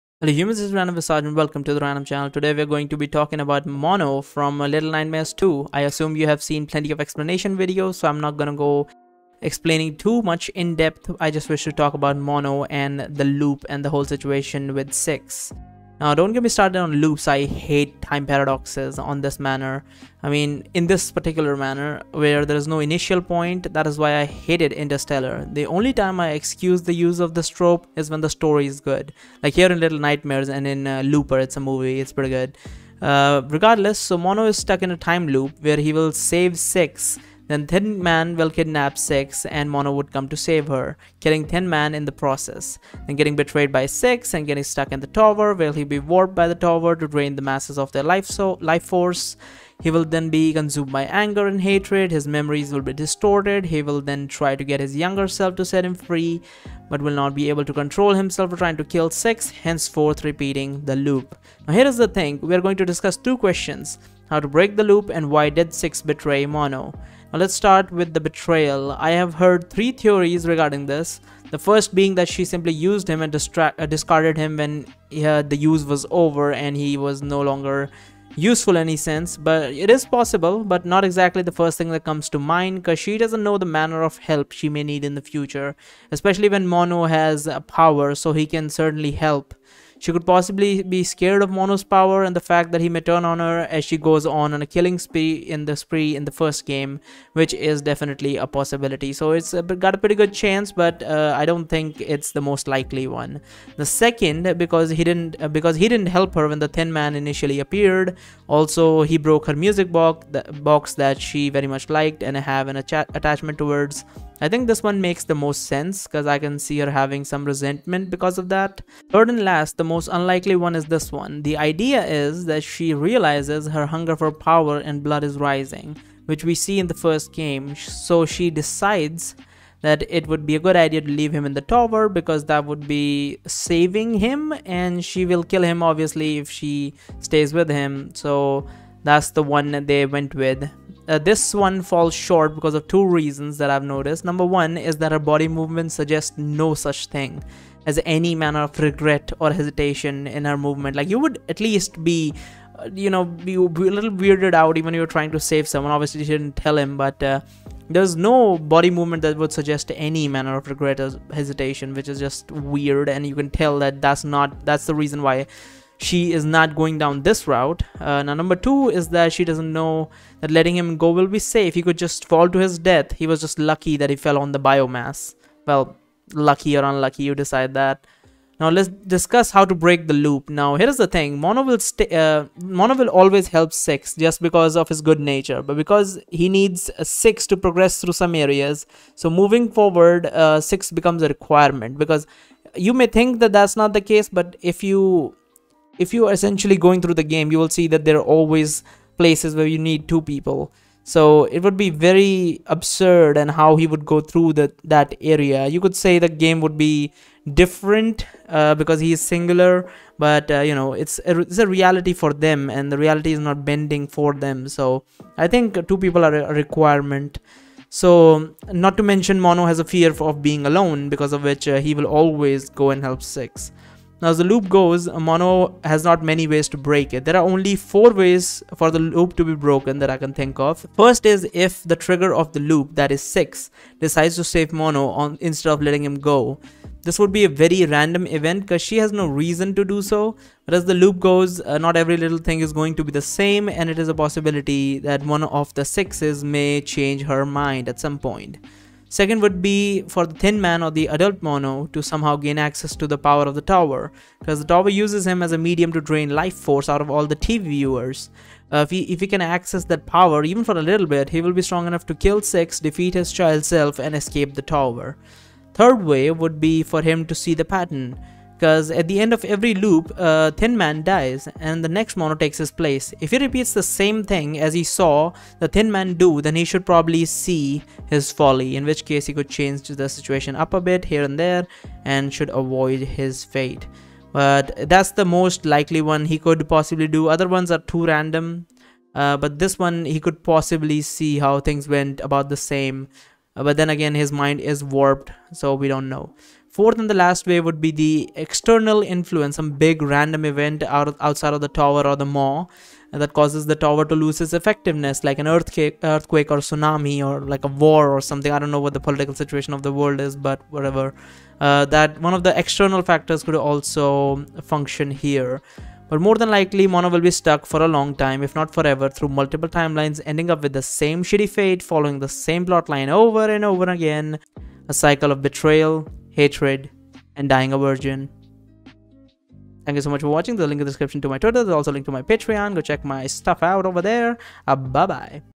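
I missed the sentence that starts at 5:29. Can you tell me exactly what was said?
Thank you so much for watching.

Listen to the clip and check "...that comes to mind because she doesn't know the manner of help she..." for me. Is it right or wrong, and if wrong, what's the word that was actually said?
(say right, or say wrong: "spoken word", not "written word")
right.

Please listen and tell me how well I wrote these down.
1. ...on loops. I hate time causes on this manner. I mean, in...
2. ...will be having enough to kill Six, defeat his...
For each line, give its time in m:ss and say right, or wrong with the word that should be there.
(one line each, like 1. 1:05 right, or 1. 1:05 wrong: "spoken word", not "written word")
1. 0:16 wrong: "paradoxes", not "causes"
2. 4:21 wrong: "strong", not "having".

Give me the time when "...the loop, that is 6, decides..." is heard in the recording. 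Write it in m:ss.
3:52.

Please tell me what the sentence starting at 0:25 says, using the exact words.
The only time I excuse the use of this trope is when the story is good.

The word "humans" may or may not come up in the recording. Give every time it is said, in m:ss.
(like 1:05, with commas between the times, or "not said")
0:00.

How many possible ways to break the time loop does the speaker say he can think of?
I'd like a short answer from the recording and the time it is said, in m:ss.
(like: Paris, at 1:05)
4, at 3:47.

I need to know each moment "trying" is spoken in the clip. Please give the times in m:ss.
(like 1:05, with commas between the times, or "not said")
0:58, 2:35.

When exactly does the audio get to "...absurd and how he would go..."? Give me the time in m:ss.
3:22.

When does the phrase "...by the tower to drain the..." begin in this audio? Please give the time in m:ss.
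0:46.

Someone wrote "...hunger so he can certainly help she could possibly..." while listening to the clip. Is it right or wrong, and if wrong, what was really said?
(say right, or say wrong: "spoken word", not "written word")
wrong: "power", not "hunger".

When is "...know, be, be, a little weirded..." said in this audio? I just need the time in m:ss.
2:33.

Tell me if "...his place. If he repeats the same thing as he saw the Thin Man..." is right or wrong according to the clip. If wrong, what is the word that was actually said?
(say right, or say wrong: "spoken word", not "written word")
right.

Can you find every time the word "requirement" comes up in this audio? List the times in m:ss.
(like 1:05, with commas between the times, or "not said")
3:11, 3:36.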